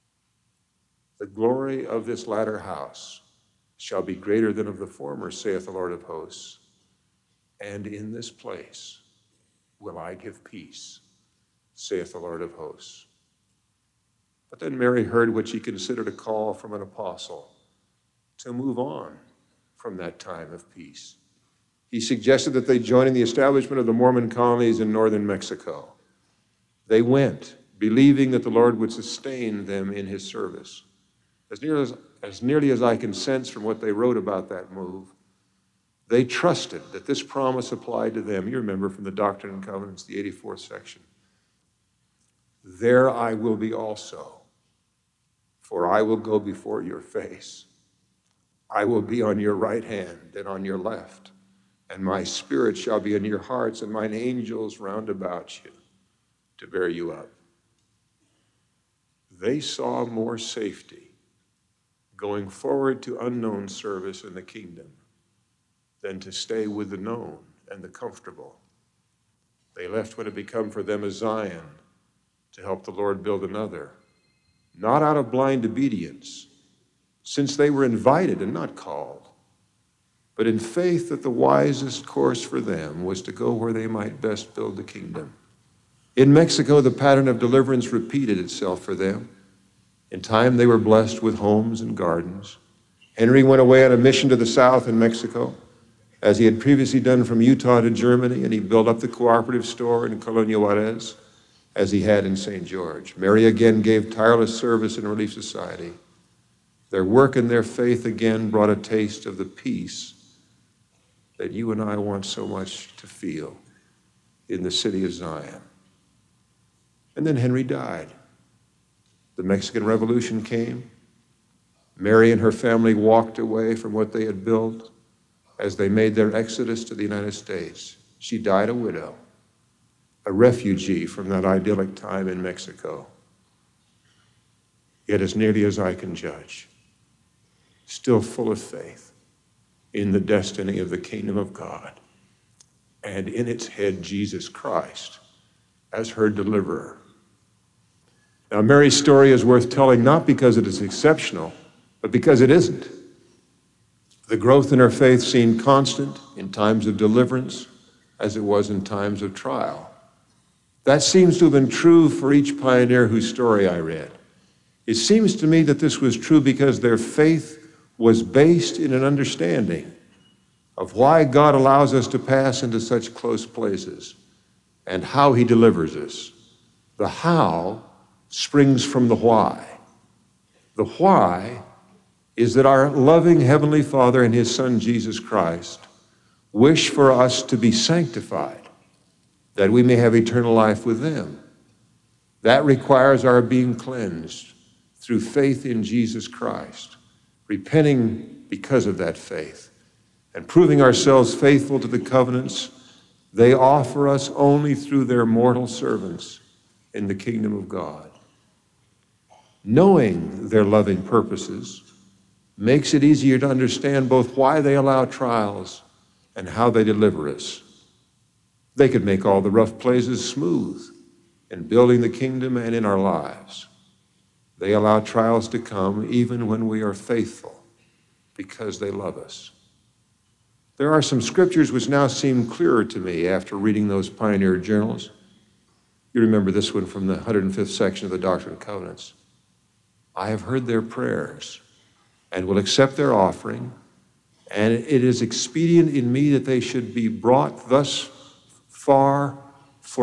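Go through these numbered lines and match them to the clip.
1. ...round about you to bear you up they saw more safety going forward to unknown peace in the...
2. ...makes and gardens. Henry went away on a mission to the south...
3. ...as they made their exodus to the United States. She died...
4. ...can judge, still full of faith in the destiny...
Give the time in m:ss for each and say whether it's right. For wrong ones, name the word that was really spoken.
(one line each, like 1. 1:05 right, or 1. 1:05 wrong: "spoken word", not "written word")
1. 0:54 wrong: "service", not "peace"
2. 1:31 wrong: "homes", not "makes"
3. 2:05 right
4. 2:15 right.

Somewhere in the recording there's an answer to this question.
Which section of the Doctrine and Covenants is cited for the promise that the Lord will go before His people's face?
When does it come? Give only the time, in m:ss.
0:40.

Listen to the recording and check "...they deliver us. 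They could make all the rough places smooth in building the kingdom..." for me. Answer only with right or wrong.
right.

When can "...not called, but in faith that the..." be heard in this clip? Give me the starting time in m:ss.
1:18.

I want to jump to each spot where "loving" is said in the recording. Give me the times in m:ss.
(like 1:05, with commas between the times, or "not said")
3:02, 3:30.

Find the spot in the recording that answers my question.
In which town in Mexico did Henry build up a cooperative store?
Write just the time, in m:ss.
1:40.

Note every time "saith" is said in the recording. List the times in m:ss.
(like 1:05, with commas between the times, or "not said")
0:05, 0:11.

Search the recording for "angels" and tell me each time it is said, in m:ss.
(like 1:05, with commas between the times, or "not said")
0:54.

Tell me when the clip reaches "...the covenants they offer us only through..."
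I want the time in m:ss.
3:21.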